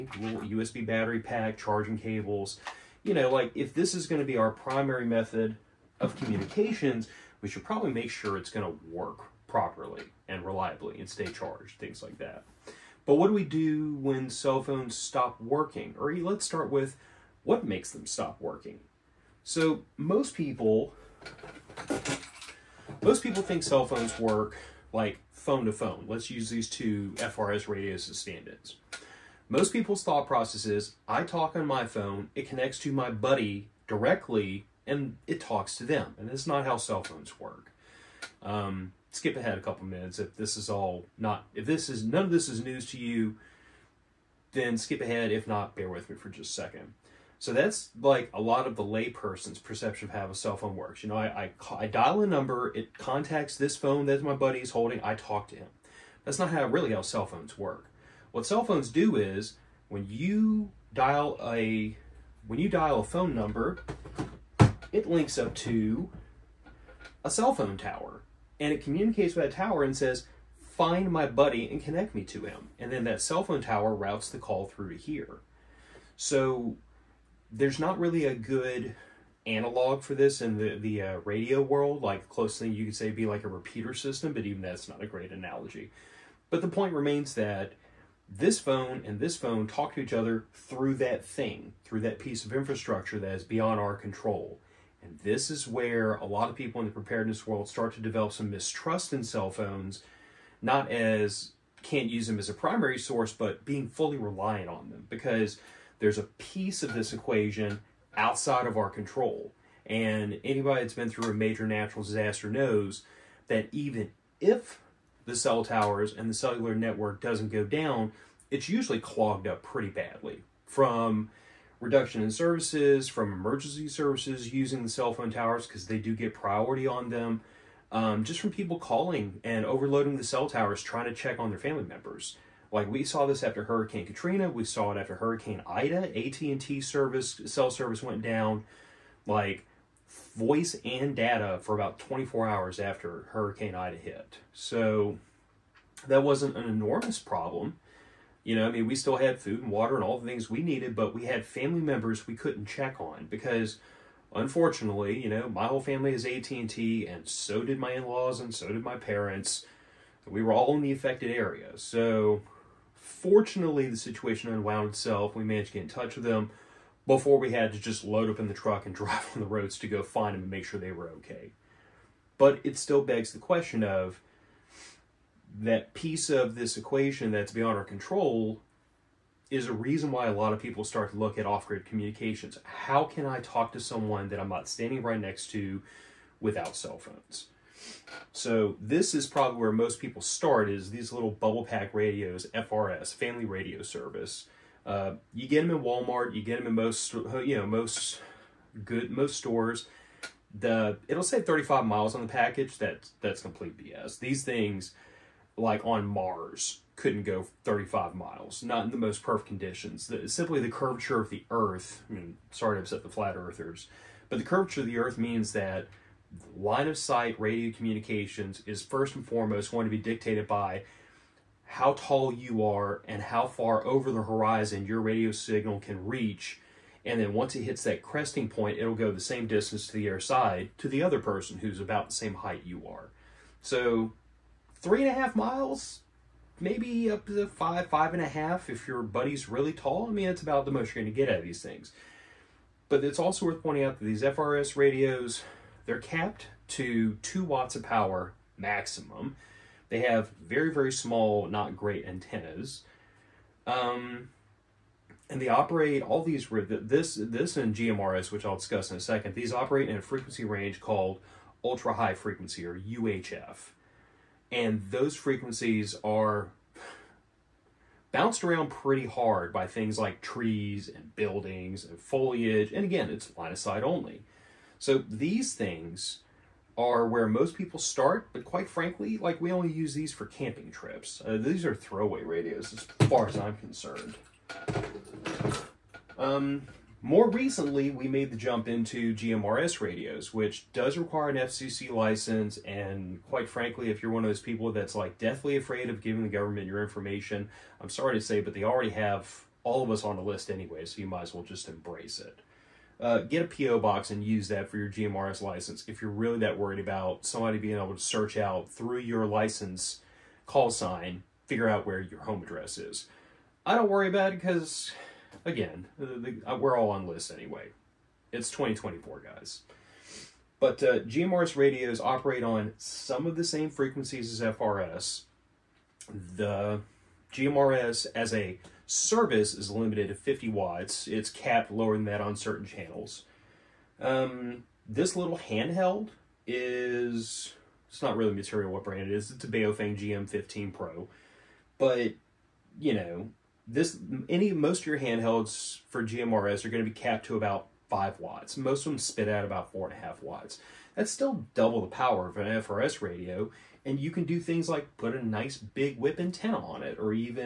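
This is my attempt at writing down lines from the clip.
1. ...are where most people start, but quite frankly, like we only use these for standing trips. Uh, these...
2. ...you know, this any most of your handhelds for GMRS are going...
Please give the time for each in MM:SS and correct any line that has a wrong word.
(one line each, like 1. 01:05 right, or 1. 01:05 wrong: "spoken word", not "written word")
1. 04:36 wrong: "camping", not "standing"
2. 05:42 right.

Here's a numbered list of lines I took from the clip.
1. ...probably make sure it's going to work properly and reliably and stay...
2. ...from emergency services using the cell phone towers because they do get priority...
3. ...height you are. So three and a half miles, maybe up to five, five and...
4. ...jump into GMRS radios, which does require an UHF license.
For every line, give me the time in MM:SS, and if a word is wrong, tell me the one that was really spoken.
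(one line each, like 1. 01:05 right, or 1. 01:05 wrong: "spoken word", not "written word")
1. 00:07 right
2. 02:03 right
3. 03:52 right
4. 04:48 wrong: "FCC", not "UHF".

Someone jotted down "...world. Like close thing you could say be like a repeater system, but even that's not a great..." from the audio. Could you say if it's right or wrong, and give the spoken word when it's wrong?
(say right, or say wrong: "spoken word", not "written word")
right.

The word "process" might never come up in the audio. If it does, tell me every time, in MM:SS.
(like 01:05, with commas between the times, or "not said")
00:30.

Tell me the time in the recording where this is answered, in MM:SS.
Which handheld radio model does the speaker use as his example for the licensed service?
05:39.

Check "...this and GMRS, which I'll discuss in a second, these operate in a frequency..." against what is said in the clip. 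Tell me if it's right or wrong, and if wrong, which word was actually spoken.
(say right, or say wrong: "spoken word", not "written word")
right.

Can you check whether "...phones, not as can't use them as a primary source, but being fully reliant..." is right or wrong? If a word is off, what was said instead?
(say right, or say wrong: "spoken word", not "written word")
right.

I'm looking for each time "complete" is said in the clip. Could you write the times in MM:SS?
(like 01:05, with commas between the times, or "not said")
03:23.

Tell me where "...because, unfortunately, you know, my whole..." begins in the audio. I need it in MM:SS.
02:33.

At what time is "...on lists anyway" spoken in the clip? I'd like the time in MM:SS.
05:16.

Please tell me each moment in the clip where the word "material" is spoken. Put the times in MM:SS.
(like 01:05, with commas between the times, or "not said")
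05:38.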